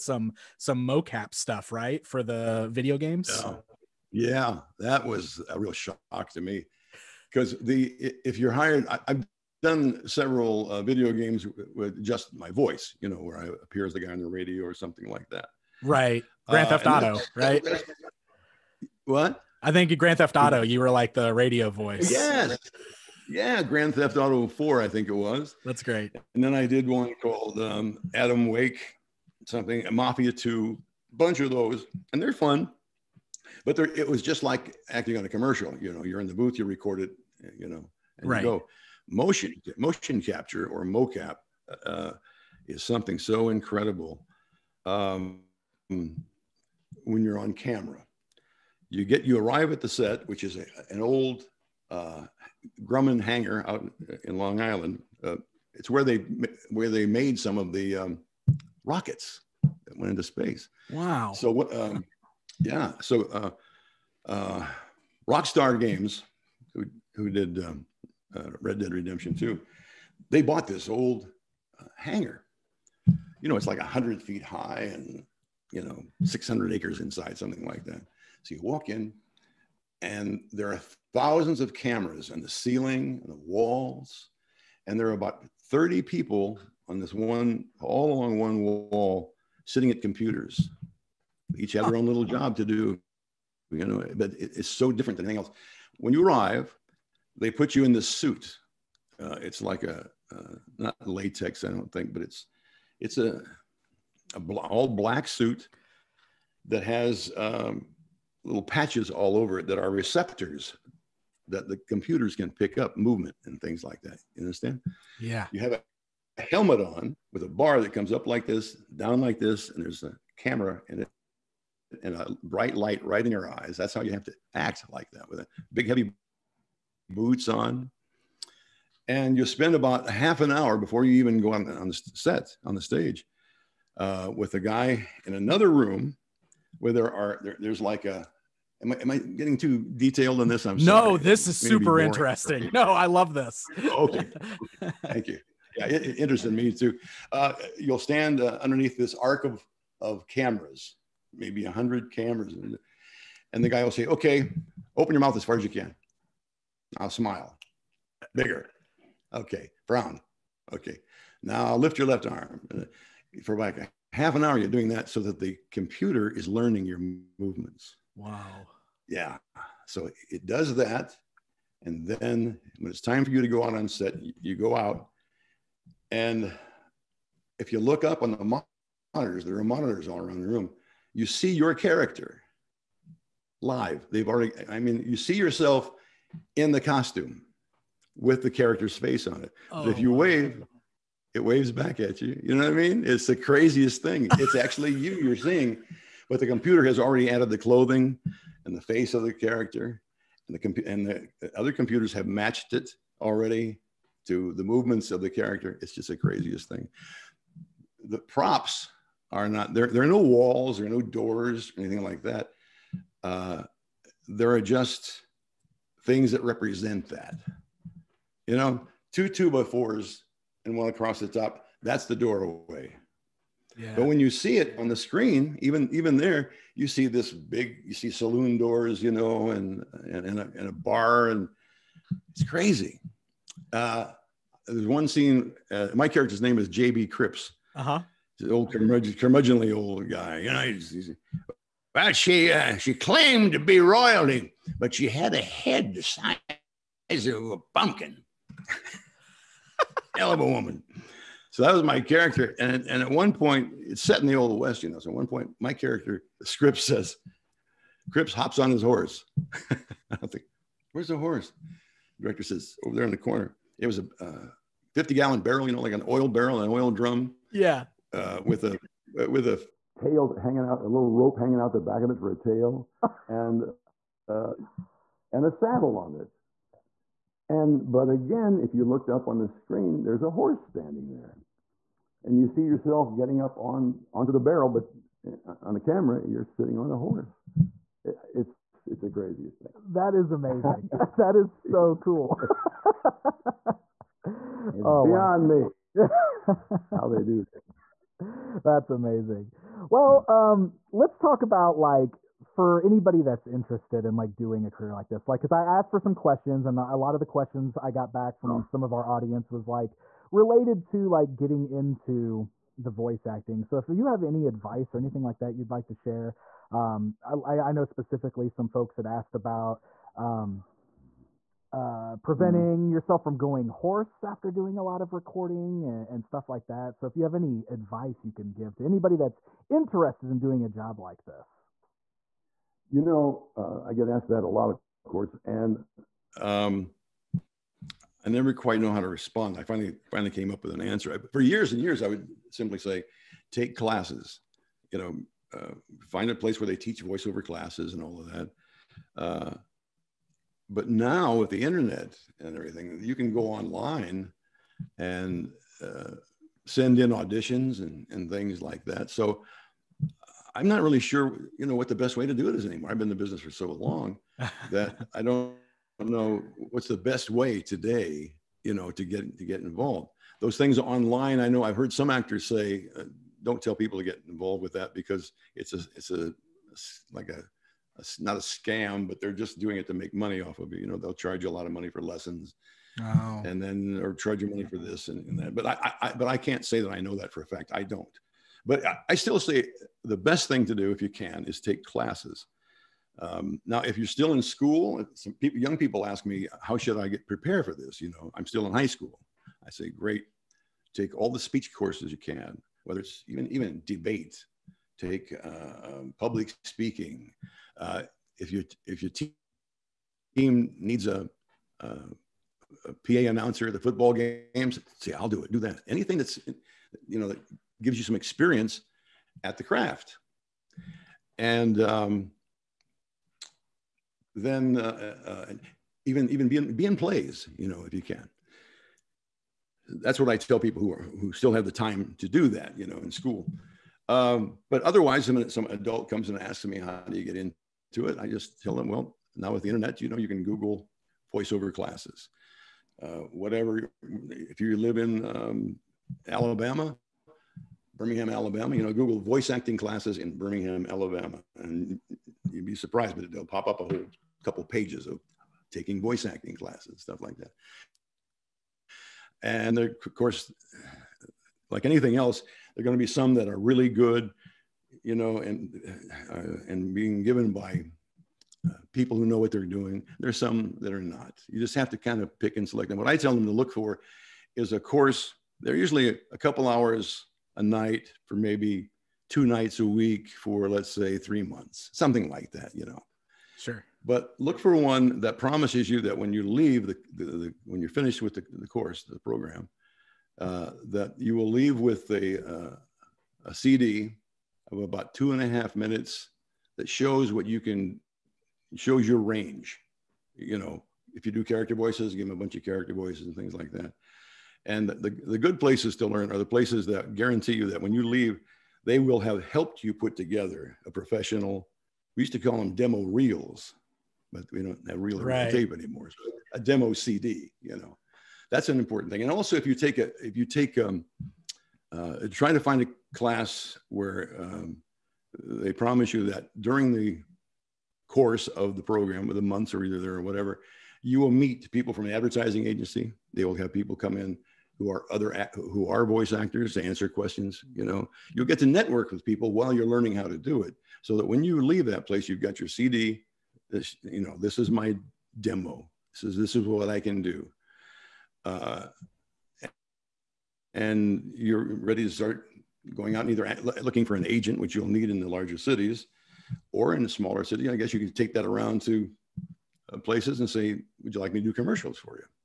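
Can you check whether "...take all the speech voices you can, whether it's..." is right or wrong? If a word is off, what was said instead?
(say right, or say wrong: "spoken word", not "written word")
wrong: "courses", not "voices".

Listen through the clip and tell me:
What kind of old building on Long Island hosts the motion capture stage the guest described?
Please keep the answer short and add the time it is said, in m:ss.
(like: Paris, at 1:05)
Grumman hangar, at 0:52.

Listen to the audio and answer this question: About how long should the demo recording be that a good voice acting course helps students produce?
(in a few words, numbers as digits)
2.5 minutes.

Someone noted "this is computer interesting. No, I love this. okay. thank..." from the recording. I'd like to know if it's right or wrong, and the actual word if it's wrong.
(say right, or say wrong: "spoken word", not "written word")
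wrong: "super", not "computer".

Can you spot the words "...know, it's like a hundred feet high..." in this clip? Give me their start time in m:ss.
1:13.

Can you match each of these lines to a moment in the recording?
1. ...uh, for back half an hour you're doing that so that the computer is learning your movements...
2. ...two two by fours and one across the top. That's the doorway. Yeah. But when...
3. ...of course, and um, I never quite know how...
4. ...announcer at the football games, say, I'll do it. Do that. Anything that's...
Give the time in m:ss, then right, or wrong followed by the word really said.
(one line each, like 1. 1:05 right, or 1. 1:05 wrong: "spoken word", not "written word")
1. 2:42 right
2. 3:39 right
3. 5:34 right
4. 6:53 right.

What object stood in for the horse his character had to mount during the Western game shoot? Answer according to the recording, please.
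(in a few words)
50 gallon barrel.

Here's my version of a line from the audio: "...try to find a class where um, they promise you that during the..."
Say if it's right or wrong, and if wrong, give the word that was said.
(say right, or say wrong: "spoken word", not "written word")
right.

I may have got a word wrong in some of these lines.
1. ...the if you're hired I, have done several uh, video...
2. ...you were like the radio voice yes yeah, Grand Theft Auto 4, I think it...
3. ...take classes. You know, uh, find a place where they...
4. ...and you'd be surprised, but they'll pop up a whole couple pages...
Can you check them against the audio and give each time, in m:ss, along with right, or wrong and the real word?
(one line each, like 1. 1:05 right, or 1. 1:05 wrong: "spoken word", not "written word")
1. 0:07 right
2. 0:20 right
3. 5:43 right
4. 7:31 right.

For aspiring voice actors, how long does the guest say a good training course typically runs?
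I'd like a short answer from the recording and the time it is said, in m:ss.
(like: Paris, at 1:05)
3 months, at 8:01.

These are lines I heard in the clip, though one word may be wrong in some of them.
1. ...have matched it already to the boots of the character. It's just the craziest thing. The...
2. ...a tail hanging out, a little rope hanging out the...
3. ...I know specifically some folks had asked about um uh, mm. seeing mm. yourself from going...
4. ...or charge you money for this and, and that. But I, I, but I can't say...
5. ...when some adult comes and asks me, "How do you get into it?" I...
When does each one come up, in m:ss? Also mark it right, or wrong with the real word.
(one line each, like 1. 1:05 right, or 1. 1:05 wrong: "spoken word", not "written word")
1. 3:22 wrong: "movements", not "boots"
2. 4:29 right
3. 5:17 wrong: "preventing", not "seeing"
4. 6:24 right
5. 7:15 right.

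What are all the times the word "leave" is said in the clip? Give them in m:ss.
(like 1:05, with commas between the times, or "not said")
8:06, 8:11, 8:28, 9:01.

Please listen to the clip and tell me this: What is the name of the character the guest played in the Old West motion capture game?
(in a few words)
J.B. Cripps.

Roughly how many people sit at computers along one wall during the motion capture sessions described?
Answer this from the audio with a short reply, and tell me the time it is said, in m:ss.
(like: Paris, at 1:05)
30, at 1:25.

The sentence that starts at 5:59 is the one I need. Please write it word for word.
So I'm not really sure, you know, what the best way to do it is anymore.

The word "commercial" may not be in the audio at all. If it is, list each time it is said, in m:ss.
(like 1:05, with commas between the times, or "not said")
0:35, 9:21.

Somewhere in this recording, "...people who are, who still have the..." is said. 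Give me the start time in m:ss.
7:10.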